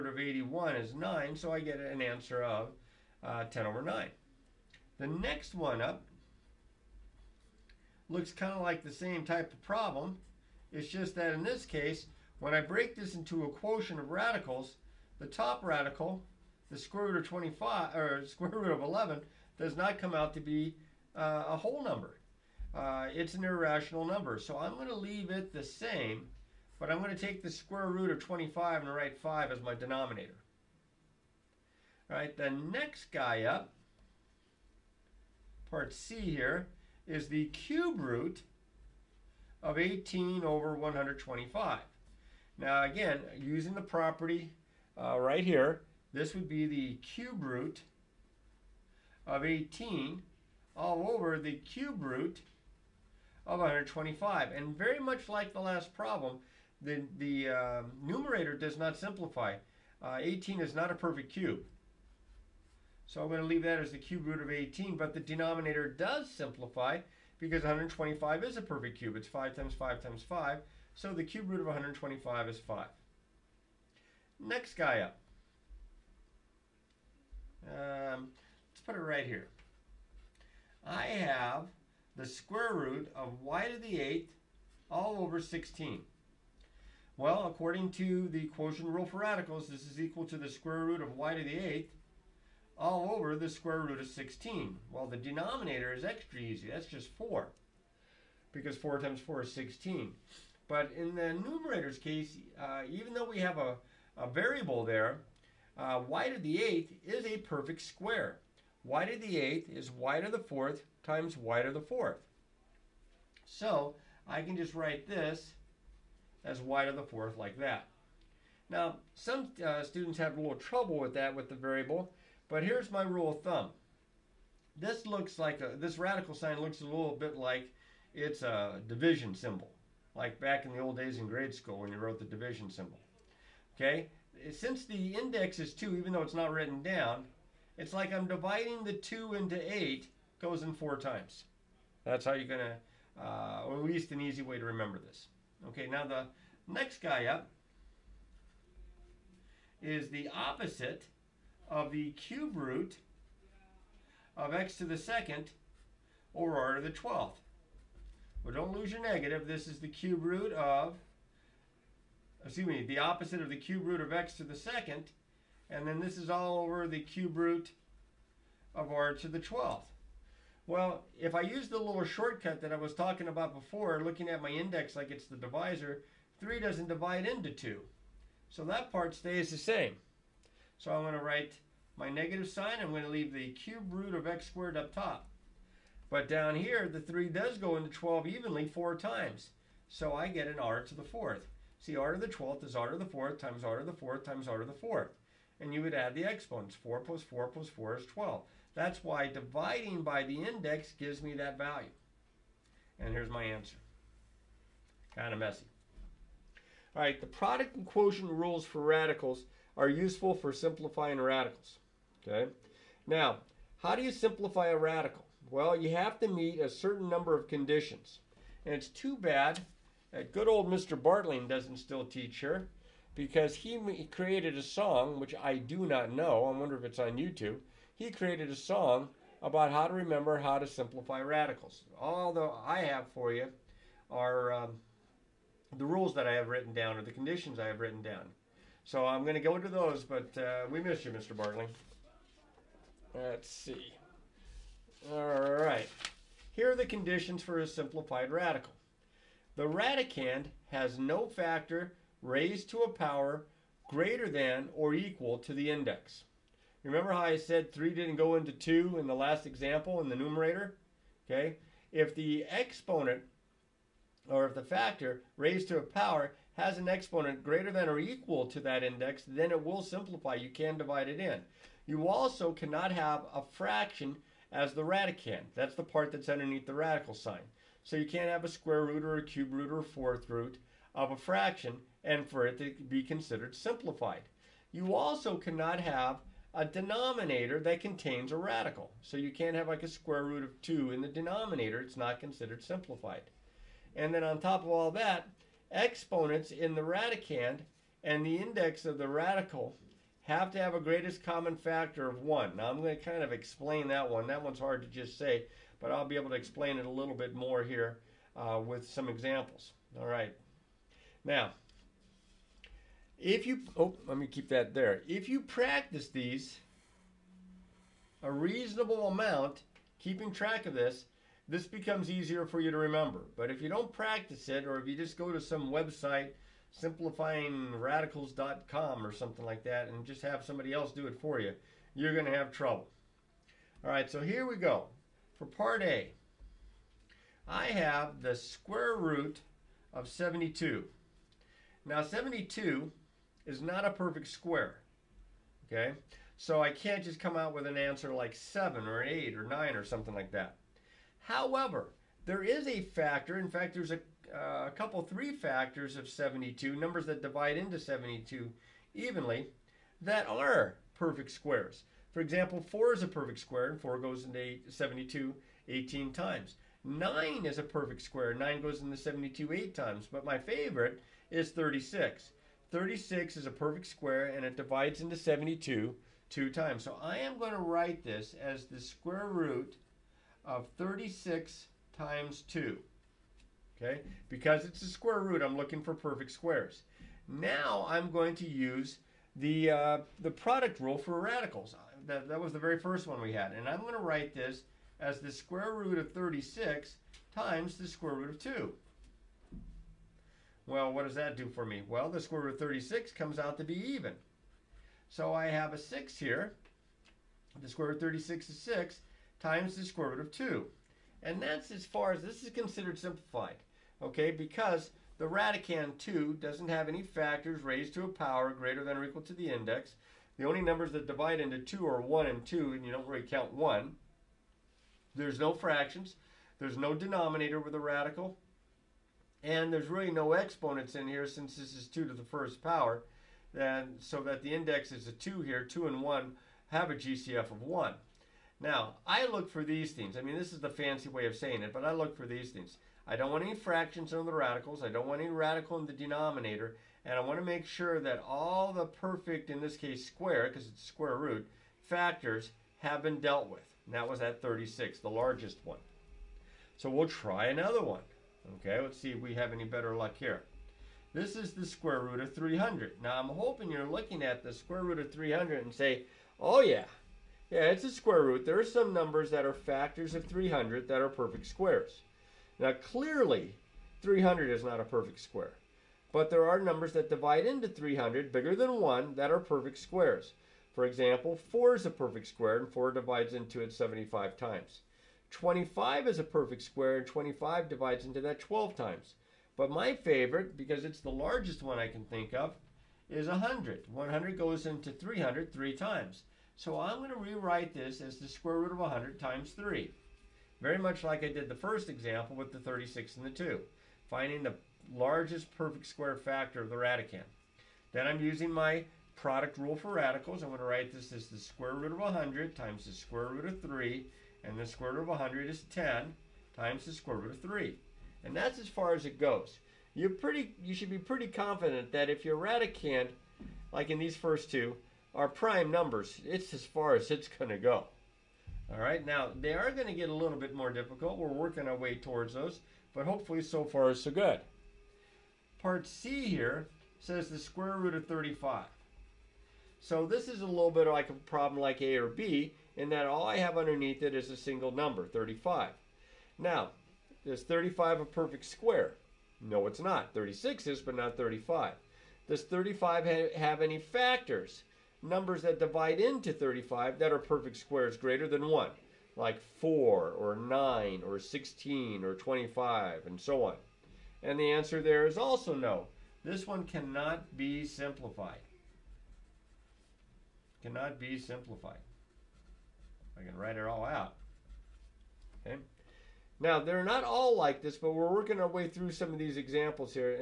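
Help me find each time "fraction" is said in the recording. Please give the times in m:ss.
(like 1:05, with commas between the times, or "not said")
4:33, 4:41, 7:05, 7:23.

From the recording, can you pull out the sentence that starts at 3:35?
Well, you have to meet a certain number of conditions.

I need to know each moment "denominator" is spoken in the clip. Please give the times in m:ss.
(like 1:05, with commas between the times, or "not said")
0:29, 1:05, 1:35, 4:46, 4:51, 7:06, 7:25.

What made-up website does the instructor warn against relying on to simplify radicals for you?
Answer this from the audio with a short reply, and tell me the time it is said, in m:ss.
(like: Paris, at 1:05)
simplifyingradicals.com, at 5:26.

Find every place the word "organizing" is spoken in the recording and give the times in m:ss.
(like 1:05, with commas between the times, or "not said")
not said.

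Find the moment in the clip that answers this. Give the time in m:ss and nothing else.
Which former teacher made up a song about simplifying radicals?
3:40.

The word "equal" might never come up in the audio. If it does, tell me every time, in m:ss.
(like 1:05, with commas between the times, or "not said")
1:29, 4:14, 4:27, 6:59.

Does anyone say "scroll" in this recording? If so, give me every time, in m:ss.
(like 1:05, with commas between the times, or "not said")
not said.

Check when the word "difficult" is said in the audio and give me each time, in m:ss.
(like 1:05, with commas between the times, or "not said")
8:50.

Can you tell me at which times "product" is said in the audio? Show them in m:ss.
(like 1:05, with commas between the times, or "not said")
3:27, 6:30, 8:29.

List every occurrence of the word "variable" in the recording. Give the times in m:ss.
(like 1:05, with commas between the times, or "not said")
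1:44, 2:01.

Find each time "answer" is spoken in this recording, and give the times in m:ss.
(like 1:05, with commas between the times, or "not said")
0:02, 3:23, 5:47, 9:24.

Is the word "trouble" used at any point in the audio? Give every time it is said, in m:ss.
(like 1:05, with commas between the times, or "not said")
2:00, 5:32.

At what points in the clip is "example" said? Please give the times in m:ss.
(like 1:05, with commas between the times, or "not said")
4:19, 5:09, 6:02, 8:00, 8:21, 9:39.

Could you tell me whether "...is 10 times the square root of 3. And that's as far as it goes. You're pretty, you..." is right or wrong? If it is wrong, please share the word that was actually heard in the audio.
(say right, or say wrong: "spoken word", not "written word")
right.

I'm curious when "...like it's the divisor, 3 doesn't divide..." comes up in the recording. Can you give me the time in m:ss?
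2:54.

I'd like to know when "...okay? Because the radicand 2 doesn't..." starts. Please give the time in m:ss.
6:54.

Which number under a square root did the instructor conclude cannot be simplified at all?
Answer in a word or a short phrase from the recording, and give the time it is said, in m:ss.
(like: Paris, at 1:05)
35, at 8:57.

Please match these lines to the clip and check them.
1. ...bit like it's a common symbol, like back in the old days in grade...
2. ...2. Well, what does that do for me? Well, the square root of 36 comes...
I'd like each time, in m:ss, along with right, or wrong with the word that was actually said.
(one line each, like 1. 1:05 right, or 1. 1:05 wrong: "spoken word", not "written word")
1. 2:07 wrong: "division", not "common"
2. 6:38 right.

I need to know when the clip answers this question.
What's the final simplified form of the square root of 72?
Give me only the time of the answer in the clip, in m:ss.
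6:48.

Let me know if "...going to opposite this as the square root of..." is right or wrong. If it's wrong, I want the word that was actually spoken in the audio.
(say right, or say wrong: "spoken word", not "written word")
wrong: "rewrite", not "opposite".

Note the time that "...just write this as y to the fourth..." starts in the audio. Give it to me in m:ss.
1:54.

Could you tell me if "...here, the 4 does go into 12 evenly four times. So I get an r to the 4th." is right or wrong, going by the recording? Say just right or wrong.
wrong.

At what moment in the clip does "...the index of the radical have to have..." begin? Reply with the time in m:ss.
4:58.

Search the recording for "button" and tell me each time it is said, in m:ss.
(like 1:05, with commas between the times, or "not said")
not said.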